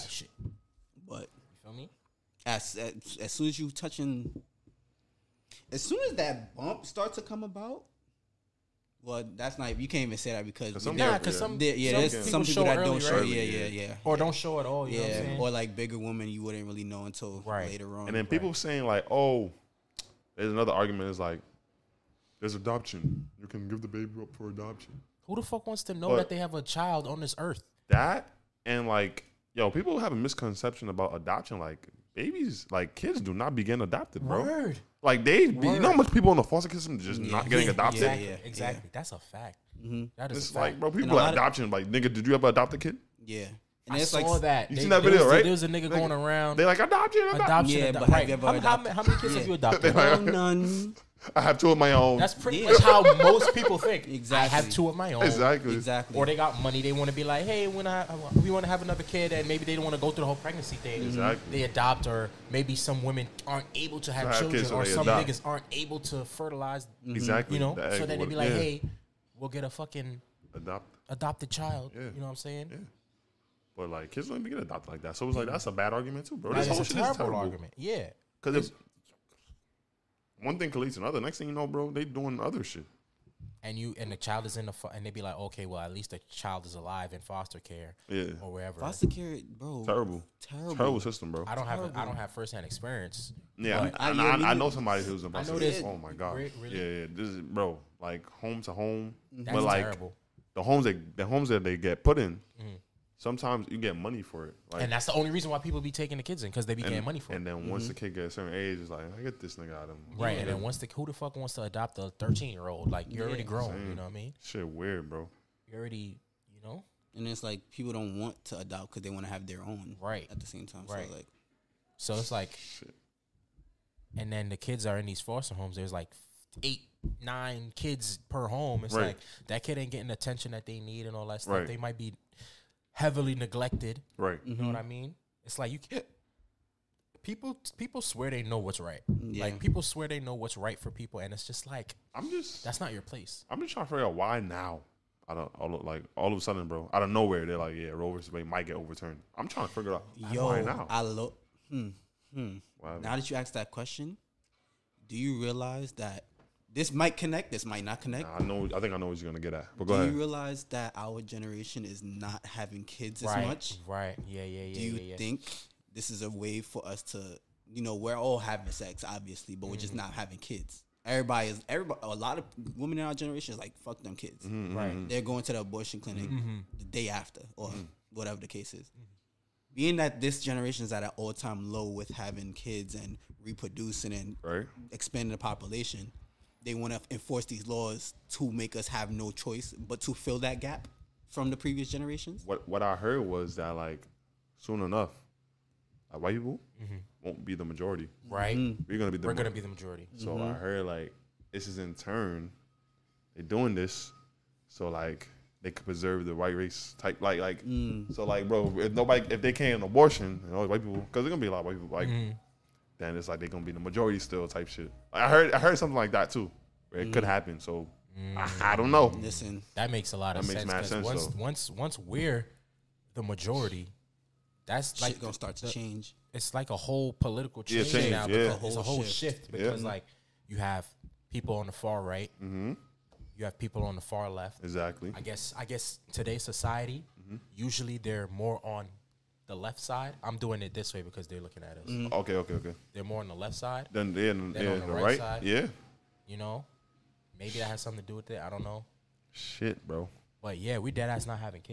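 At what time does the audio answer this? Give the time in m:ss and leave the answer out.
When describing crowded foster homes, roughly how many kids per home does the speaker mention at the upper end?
2:07.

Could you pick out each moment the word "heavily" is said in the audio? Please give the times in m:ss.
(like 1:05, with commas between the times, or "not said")
2:12.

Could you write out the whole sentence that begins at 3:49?
like you have people on the far right.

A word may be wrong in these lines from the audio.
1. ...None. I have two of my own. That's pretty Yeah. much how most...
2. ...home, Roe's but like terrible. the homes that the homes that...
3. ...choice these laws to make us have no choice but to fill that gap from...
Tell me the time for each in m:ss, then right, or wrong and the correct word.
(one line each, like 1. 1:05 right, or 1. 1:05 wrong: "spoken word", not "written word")
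1. 0:49 right
2. 1:38 wrong: "That", not "Roe"
3. 3:07 wrong: "enforce", not "choice".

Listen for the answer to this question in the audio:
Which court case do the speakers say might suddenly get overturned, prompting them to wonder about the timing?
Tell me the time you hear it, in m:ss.
2:27.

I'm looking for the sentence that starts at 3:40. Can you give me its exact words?
Because once once once we're the majority, that's shit like gonna start to the, change.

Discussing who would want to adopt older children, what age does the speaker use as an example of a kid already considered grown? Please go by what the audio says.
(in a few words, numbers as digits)
13.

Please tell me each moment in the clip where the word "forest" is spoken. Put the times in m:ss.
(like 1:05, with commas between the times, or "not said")
not said.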